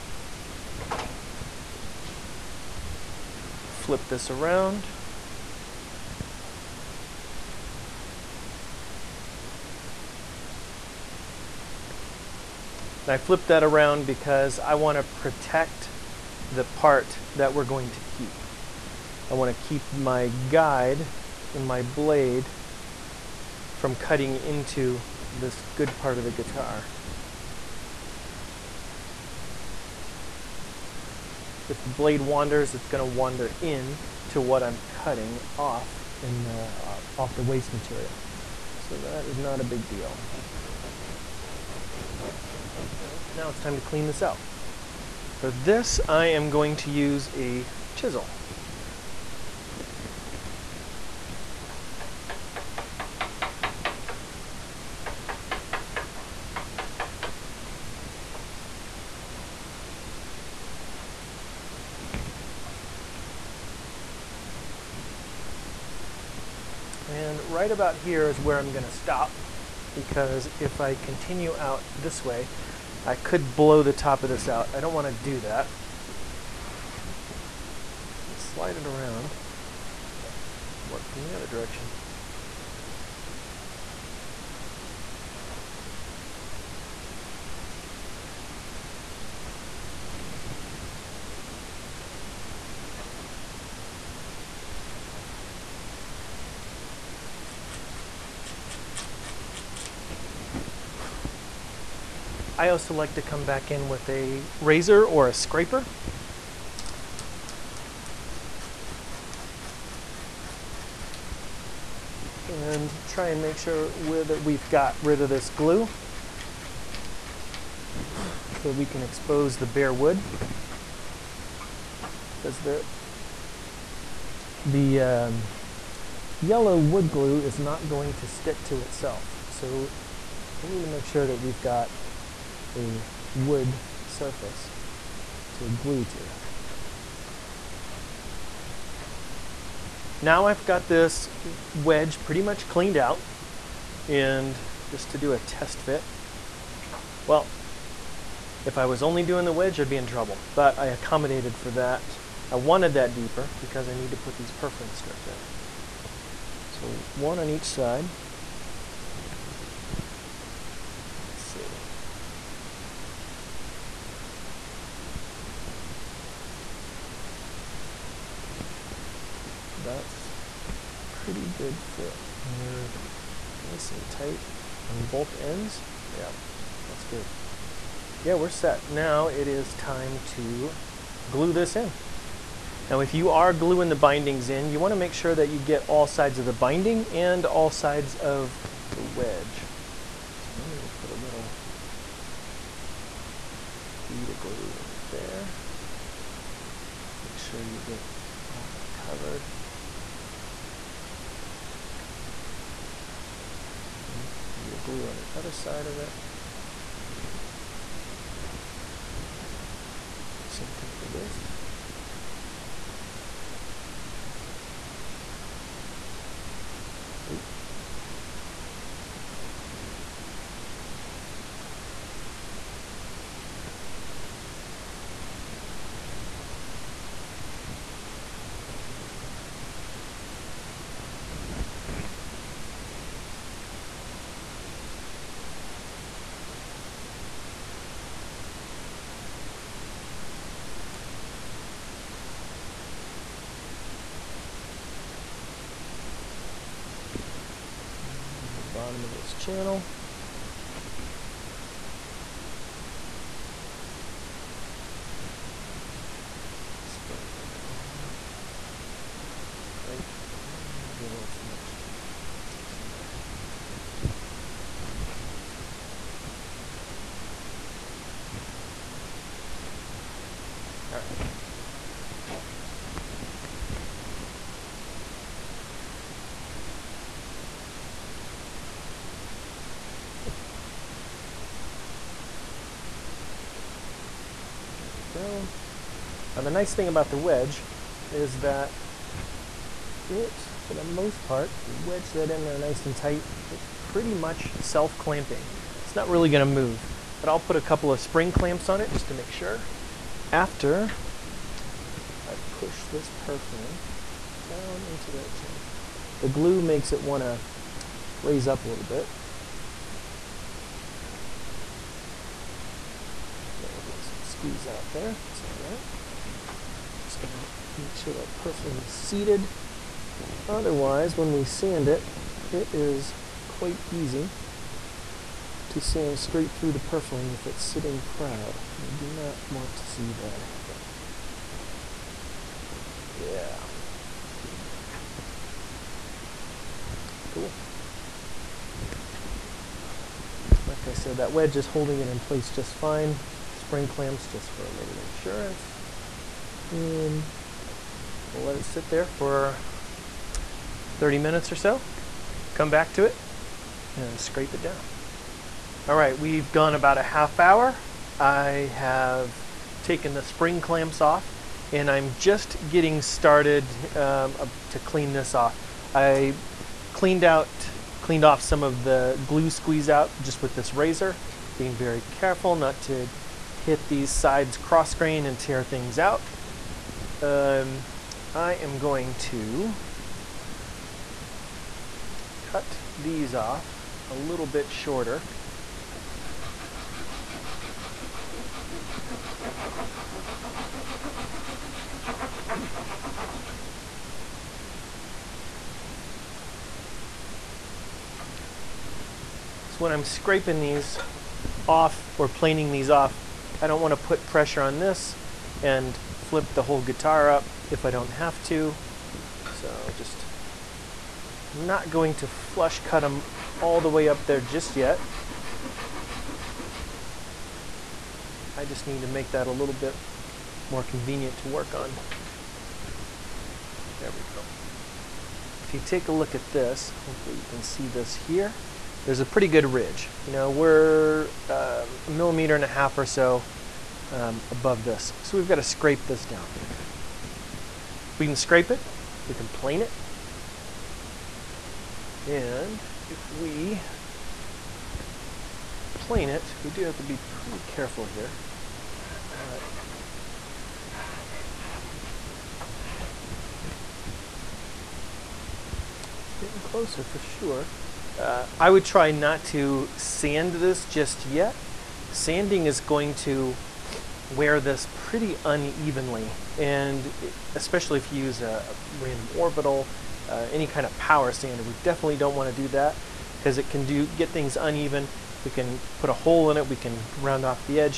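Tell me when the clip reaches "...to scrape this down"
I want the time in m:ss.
7:15.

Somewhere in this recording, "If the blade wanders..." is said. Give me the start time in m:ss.
0:31.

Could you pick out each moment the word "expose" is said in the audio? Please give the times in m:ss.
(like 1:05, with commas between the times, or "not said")
1:59.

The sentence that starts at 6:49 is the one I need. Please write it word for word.
So just I'm not going to flush cut them all the way up there just yet.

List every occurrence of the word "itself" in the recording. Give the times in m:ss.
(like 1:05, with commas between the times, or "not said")
2:08.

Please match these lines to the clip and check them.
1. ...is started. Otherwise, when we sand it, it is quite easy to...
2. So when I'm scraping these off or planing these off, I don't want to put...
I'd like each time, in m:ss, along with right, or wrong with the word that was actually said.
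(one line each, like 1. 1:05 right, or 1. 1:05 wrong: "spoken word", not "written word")
1. 5:18 wrong: "seated", not "started"
2. 6:39 right.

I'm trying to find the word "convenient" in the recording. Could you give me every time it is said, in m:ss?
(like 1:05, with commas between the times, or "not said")
7:00.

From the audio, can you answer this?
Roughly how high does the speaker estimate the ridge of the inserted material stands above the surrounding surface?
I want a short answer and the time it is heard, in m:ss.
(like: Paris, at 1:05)
1.5 millimeters, at 7:12.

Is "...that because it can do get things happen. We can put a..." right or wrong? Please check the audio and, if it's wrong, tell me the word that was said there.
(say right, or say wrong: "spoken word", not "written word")
wrong: "uneven", not "happen".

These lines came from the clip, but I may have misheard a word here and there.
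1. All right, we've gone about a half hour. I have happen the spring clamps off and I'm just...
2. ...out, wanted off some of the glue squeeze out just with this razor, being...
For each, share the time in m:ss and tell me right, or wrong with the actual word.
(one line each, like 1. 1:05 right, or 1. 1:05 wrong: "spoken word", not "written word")
1. 5:55 wrong: "taken", not "happen"
2. 6:07 wrong: "cleaned", not "wanted".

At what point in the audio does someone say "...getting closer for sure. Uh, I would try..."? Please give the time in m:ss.
7:36.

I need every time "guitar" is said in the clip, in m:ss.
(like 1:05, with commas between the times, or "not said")
0:26, 6:46.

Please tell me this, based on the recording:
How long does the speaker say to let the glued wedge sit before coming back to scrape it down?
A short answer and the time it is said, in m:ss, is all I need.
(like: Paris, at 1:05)
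30 minutes, at 5:50.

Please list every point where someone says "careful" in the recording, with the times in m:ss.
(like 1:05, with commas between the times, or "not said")
6:12, 7:27.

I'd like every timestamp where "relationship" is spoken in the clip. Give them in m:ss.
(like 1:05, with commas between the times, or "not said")
not said.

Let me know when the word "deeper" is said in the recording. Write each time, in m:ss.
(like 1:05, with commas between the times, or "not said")
2:33.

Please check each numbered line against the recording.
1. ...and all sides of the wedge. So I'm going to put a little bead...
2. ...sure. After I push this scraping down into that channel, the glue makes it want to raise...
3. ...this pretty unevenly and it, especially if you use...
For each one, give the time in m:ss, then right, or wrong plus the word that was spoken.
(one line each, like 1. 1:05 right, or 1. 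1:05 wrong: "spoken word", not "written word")
1. 3:07 right
2. 4:59 wrong: "purfling", not "scraping"
3. 7:44 right.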